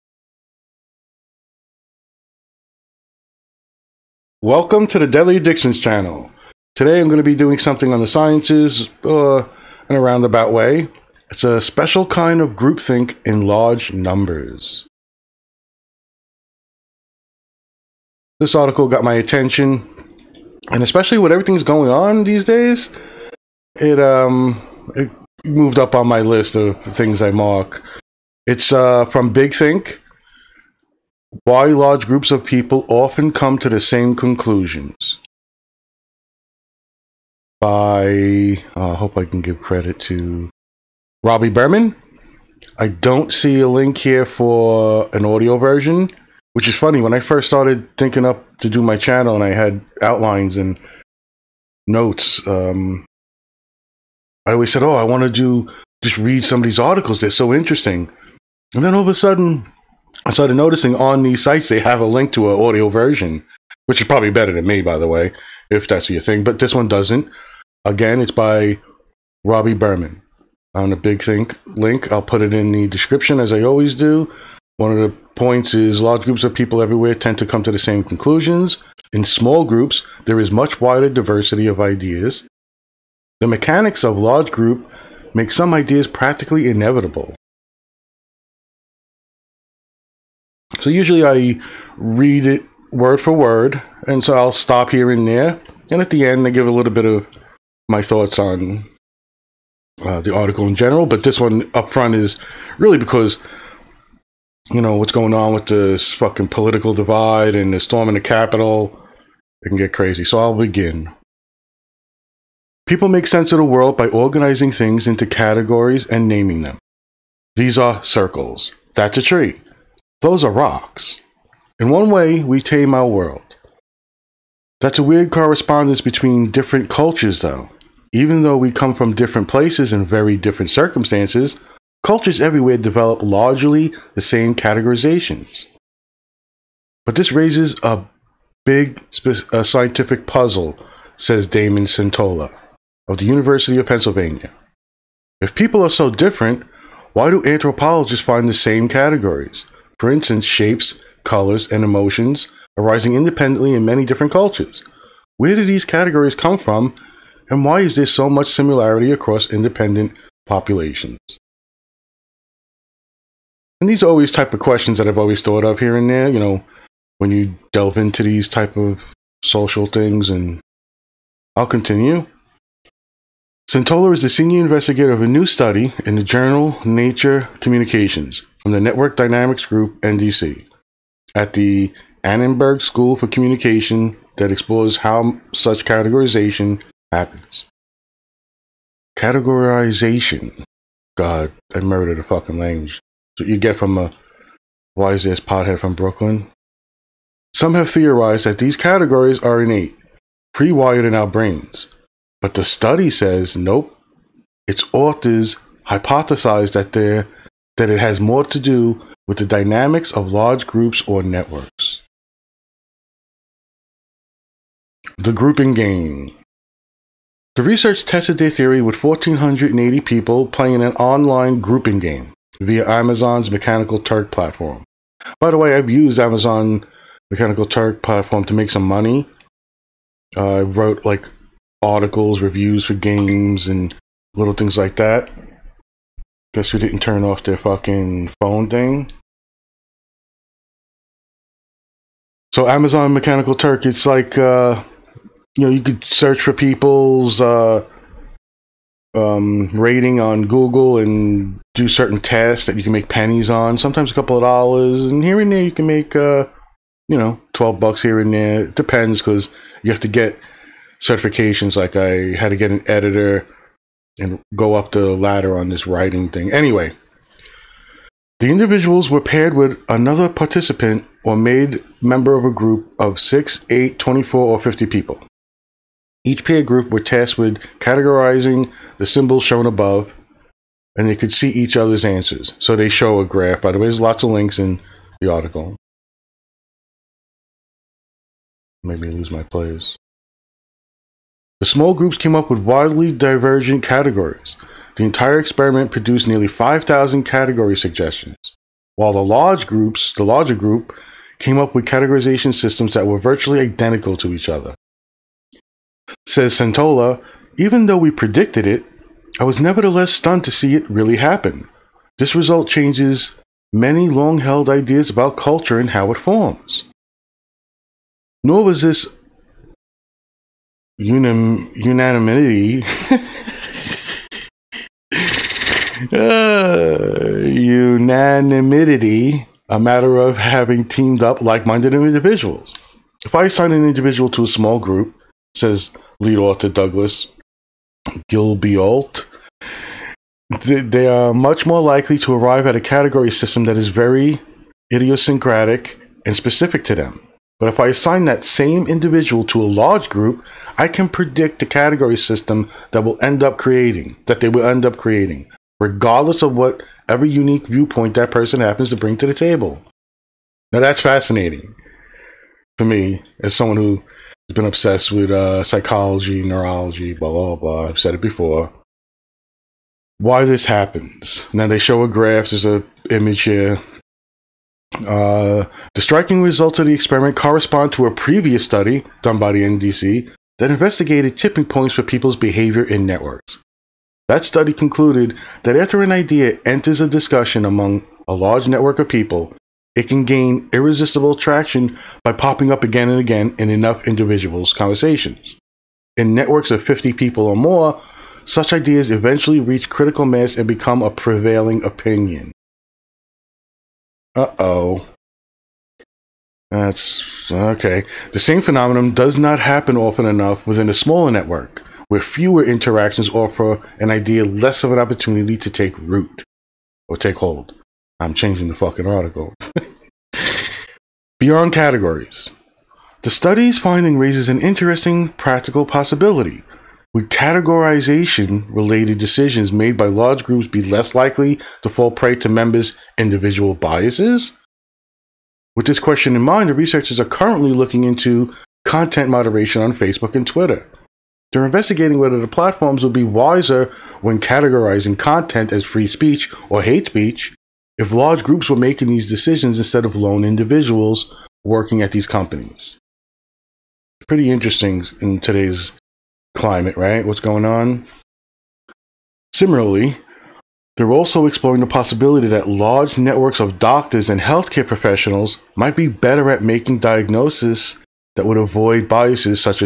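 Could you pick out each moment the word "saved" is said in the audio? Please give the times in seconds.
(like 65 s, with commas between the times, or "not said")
not said.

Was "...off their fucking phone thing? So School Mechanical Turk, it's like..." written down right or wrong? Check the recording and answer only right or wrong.
wrong.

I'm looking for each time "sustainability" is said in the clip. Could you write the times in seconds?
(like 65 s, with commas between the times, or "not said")
not said.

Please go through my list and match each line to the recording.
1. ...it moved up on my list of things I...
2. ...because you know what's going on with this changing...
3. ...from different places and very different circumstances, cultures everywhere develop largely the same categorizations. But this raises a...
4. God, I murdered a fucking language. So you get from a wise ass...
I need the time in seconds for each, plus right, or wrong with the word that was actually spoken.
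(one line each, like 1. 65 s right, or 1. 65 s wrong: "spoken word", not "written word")
1. 24 s right
2. 102 s wrong: "fucking", not "changing"
3. 128 s right
4. 191 s right.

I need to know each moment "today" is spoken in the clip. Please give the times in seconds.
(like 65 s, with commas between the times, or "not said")
6 s, 455 s.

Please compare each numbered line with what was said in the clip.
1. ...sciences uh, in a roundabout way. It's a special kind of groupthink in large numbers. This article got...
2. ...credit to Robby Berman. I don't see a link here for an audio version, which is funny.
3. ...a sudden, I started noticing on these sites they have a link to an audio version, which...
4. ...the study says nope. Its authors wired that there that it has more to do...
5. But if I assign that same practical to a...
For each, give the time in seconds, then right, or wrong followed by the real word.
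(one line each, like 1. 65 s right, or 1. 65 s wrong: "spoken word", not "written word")
1. 8 s right
2. 39 s right
3. 59 s right
4. 202 s wrong: "hypothesized", not "wired"
5. 347 s wrong: "individual", not "practical".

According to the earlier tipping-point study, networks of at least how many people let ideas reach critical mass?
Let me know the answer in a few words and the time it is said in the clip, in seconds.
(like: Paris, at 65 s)
50, at 396 s.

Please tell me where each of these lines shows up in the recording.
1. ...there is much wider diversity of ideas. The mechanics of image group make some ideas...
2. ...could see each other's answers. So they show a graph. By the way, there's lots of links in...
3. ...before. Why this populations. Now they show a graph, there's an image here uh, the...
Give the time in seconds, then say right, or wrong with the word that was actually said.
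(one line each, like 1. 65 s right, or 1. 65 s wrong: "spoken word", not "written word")
1. 80 s wrong: "large", not "image"
2. 281 s right
3. 368 s wrong: "happens", not "populations".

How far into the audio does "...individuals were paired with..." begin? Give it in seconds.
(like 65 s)
268 s.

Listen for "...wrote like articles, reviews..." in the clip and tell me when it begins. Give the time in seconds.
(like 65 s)
230 s.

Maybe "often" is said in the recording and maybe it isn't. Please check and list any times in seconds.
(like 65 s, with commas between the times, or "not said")
32 s, 409 s.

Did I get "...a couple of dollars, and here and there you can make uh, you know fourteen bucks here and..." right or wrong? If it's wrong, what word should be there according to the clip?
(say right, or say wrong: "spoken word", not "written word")
wrong: "twelve", not "fourteen".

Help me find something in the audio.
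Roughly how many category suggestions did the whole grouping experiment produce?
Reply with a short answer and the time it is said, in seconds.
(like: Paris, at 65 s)
nearly 5,000, at 296 s.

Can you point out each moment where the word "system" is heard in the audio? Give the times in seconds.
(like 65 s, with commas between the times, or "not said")
302 s, 343 s, 352 s.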